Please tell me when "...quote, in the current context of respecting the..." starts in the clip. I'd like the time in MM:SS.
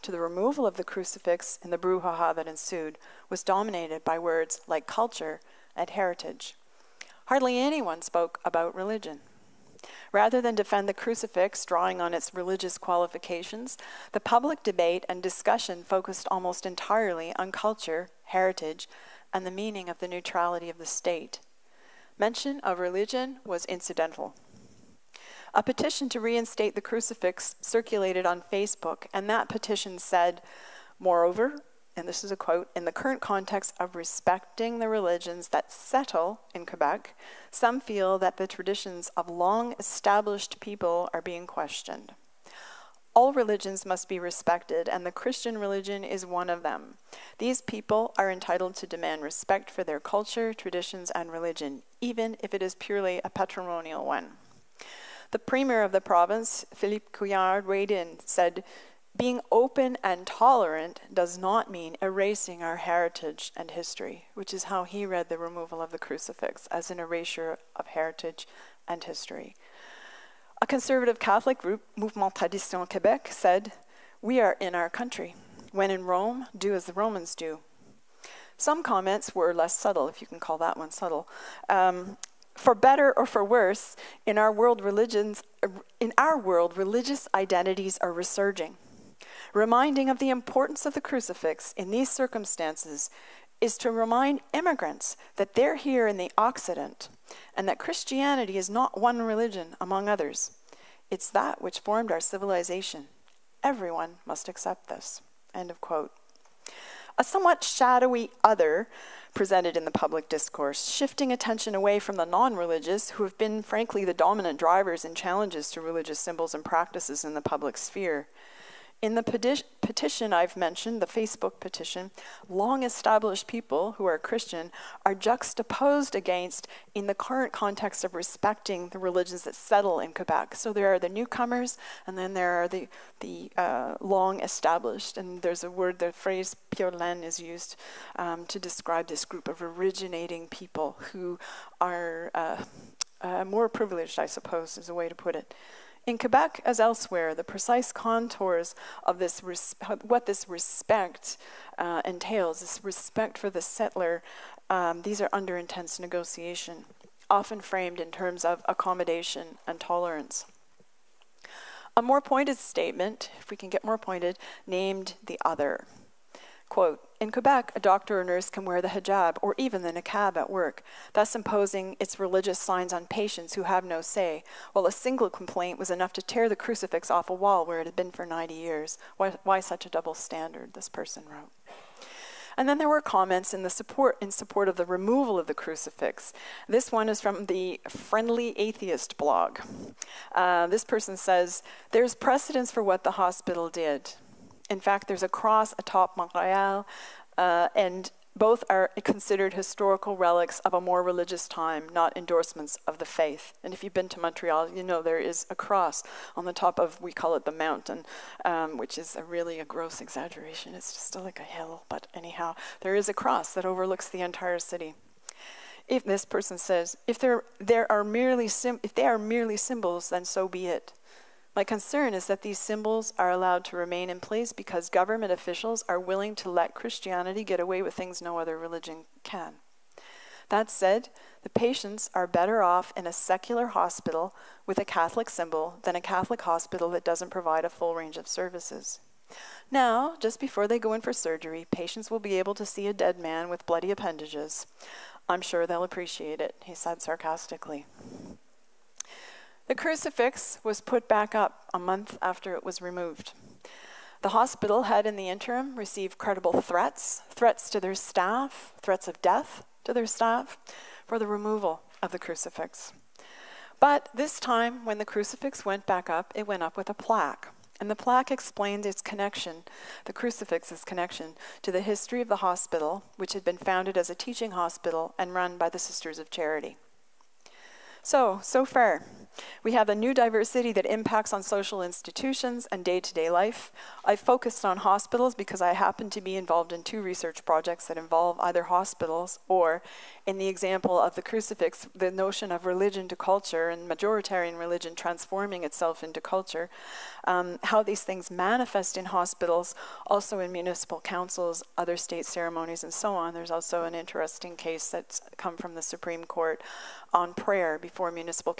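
00:32.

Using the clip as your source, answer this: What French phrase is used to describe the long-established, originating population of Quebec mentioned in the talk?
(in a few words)
pure laine.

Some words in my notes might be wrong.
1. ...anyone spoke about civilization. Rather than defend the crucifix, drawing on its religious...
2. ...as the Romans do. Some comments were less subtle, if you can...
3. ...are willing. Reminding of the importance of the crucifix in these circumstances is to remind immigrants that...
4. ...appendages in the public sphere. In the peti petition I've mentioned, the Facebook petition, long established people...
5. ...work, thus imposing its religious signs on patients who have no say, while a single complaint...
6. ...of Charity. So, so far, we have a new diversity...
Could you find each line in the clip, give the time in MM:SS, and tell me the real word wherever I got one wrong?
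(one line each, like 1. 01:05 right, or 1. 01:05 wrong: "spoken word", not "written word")
1. 00:07 wrong: "religion", not "civilization"
2. 01:16 right
3. 01:28 wrong: "resurging", not "willing"
4. 01:56 wrong: "practices", not "appendages"
5. 02:50 right
6. 04:36 right.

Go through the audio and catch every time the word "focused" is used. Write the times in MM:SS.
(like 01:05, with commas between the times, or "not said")
00:15, 04:44.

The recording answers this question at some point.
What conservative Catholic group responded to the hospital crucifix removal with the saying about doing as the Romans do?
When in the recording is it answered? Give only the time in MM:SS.
01:11.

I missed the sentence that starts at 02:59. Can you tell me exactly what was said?
Why, why such a double standard, this person wrote.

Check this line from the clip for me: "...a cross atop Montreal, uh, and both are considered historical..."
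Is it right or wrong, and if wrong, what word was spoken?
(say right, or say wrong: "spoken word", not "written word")
right.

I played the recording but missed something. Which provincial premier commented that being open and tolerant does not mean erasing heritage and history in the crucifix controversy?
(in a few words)
Philippe Couillard.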